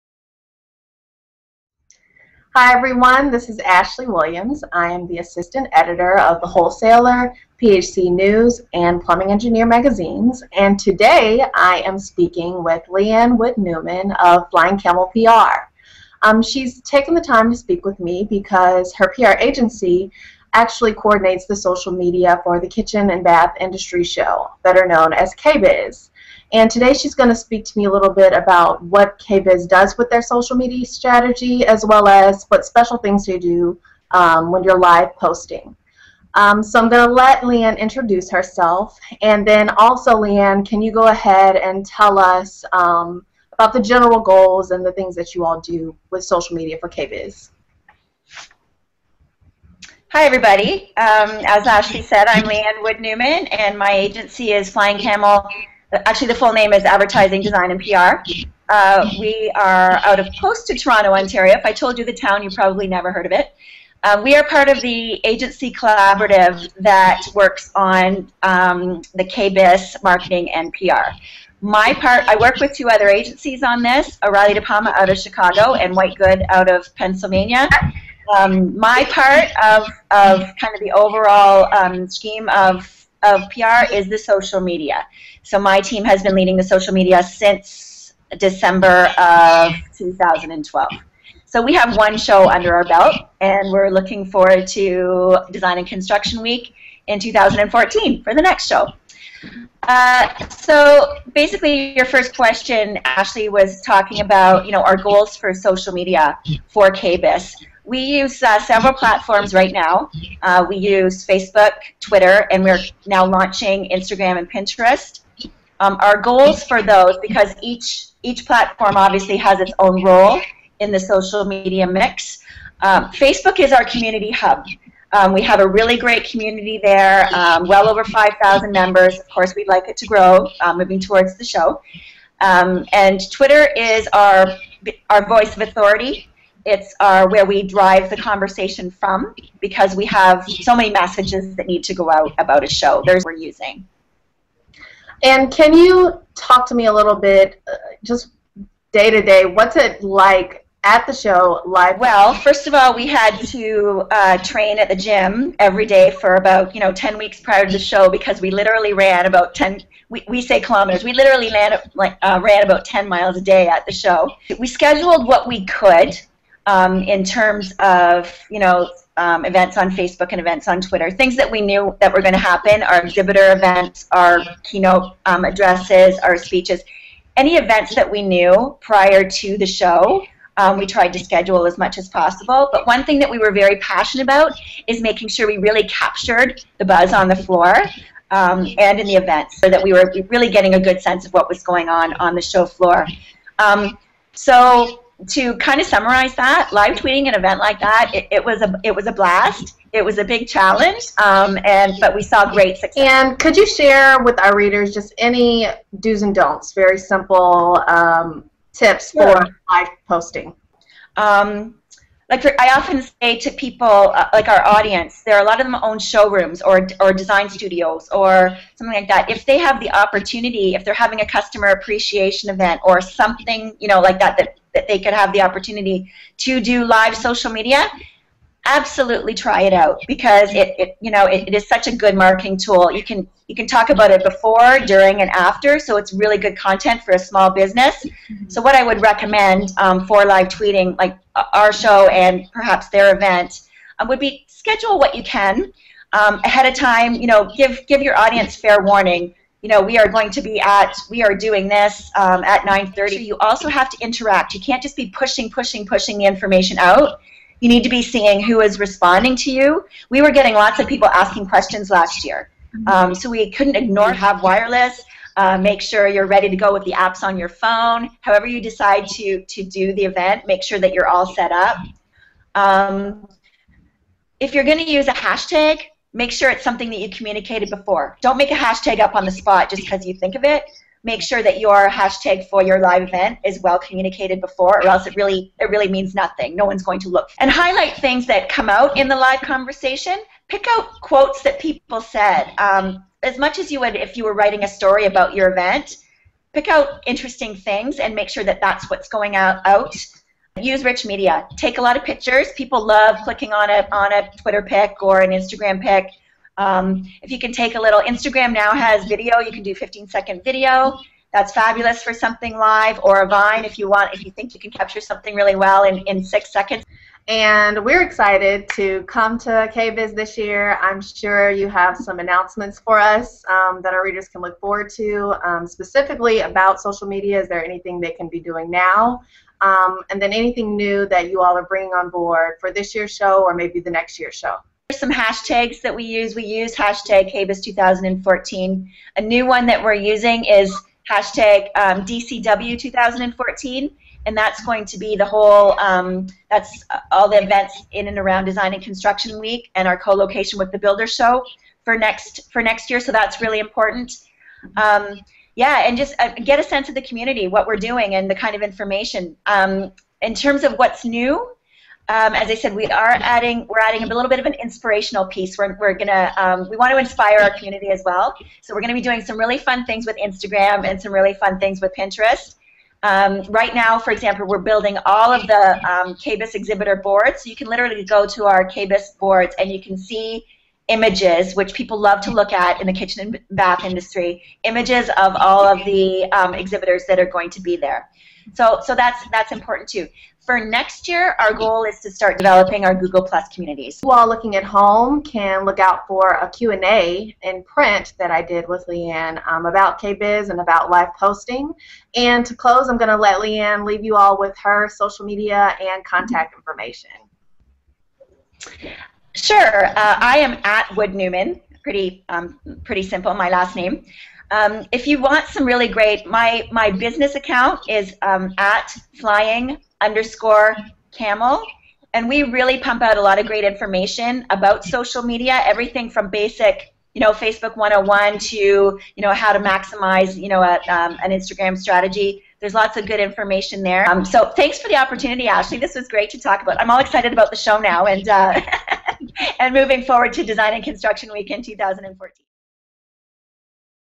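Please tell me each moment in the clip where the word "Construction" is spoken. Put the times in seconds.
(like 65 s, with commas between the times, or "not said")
95 s, 348 s, 440 s.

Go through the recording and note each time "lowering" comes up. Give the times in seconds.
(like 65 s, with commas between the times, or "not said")
not said.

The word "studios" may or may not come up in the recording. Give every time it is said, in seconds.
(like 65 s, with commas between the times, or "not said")
217 s.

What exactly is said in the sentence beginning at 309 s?
You can do 15 second video.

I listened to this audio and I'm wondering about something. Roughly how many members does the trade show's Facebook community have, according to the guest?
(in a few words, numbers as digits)
over 5,000.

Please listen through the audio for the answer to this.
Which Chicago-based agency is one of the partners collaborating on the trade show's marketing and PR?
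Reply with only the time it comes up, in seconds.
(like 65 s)
74 s.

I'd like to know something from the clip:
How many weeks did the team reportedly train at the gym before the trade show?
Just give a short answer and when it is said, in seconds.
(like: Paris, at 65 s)
10, at 156 s.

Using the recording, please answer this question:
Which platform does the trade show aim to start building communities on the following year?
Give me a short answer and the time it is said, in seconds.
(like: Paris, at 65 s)
Google Plus, at 392 s.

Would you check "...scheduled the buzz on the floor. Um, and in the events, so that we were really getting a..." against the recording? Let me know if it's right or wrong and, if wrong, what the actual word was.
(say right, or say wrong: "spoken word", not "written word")
wrong: "captured", not "scheduled".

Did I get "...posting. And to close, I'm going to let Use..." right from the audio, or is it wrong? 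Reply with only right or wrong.
wrong.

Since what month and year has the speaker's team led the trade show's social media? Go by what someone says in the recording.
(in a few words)
December 2012.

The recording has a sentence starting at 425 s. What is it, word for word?
Everything from basic, you know, Facebook 101 to you know how to maximize, you know, a, um, an Instagram strategy.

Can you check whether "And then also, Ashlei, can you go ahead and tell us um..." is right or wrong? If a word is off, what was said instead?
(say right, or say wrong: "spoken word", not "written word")
wrong: "Leanne", not "Ashlei".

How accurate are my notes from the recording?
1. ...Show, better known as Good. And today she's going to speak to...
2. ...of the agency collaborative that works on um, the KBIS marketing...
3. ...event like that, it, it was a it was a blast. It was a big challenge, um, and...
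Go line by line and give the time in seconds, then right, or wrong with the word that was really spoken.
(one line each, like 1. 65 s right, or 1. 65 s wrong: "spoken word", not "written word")
1. 24 s wrong: "KBIS", not "Good"
2. 64 s right
3. 197 s right.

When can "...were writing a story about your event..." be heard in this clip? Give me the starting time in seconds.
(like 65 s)
294 s.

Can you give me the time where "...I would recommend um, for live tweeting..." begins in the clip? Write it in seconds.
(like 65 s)
238 s.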